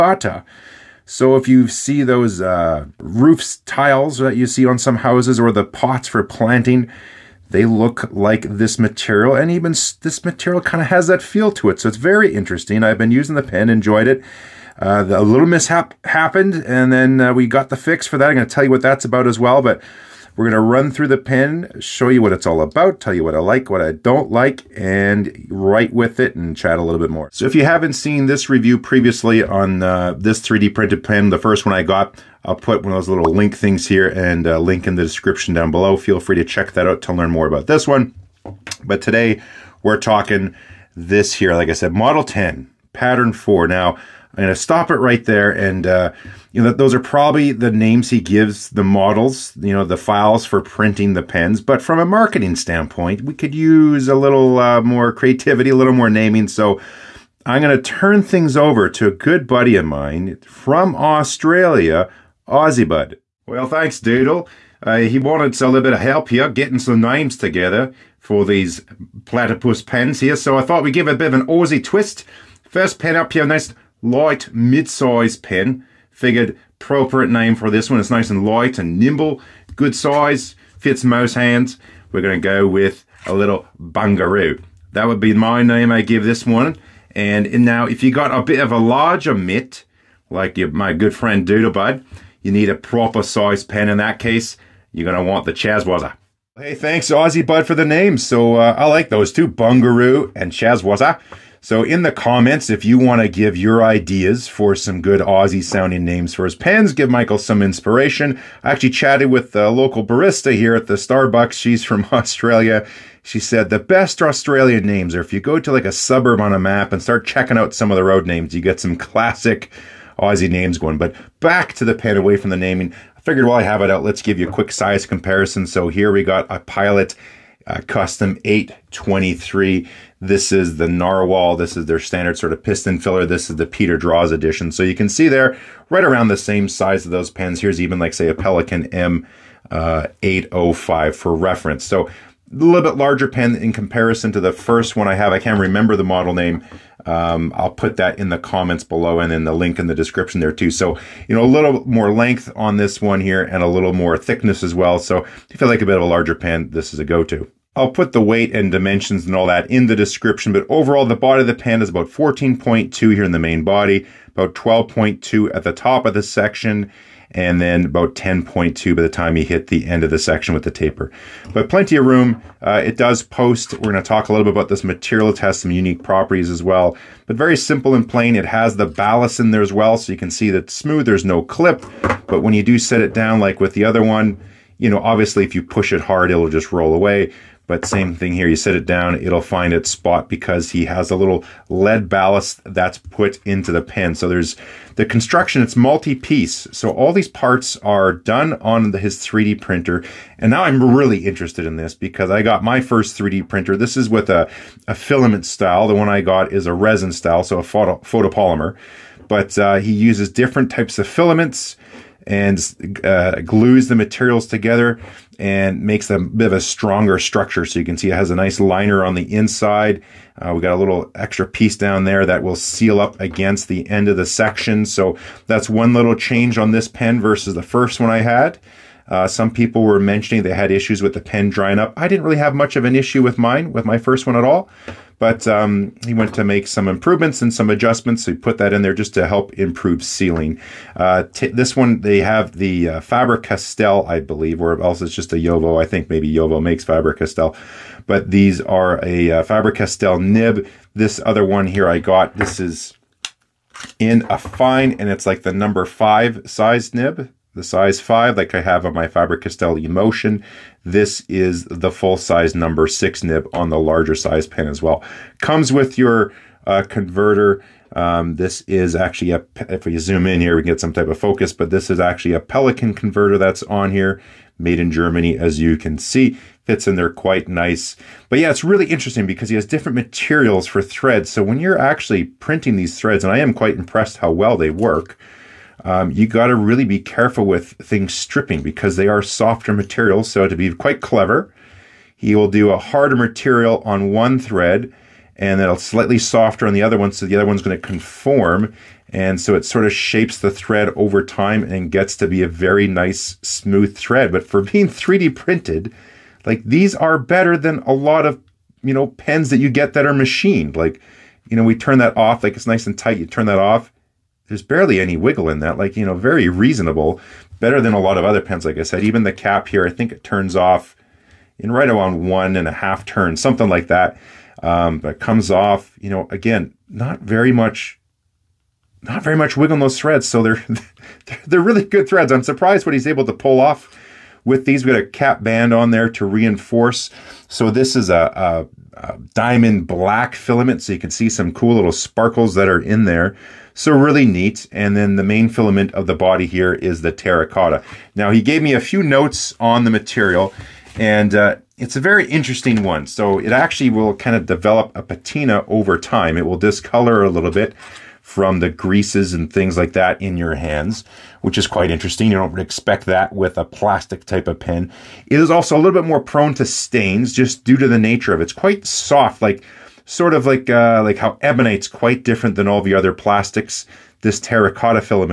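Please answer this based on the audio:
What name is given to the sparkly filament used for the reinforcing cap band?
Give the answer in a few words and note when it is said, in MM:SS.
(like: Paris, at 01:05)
diamond black, at 05:39.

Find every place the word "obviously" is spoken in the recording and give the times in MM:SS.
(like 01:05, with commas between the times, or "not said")
03:04.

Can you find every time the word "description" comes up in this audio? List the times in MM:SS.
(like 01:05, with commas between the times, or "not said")
00:35, 02:29, 02:39.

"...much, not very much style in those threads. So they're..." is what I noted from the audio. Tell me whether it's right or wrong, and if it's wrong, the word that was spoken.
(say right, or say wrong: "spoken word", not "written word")
wrong: "wiggle", not "style".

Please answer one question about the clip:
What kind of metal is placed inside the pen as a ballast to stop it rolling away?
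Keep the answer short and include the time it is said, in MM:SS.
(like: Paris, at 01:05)
lead, at 03:11.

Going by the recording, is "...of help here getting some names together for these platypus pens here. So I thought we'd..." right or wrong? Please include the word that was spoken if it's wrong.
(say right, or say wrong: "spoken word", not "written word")
right.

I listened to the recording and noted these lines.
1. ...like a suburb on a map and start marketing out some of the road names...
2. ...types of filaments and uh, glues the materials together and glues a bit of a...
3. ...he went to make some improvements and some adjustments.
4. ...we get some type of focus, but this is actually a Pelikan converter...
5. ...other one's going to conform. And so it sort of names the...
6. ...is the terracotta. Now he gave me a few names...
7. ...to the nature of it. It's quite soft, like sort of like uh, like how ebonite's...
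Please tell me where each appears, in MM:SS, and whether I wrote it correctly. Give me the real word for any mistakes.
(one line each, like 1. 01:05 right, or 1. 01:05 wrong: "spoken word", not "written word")
1. 01:55 wrong: "checking", not "marketing"
2. 03:30 wrong: "makes", not "glues"
3. 03:56 right
4. 04:30 right
5. 04:57 wrong: "shapes", not "names"
6. 05:46 wrong: "notes", not "names"
7. 06:07 right.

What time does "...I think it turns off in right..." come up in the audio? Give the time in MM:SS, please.
05:19.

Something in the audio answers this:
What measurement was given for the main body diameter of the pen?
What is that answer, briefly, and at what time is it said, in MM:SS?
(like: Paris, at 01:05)
14.2, at 02:42.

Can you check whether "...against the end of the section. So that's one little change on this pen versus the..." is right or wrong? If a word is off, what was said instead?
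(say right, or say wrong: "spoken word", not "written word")
right.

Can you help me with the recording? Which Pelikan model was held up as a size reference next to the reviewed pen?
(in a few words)
M805.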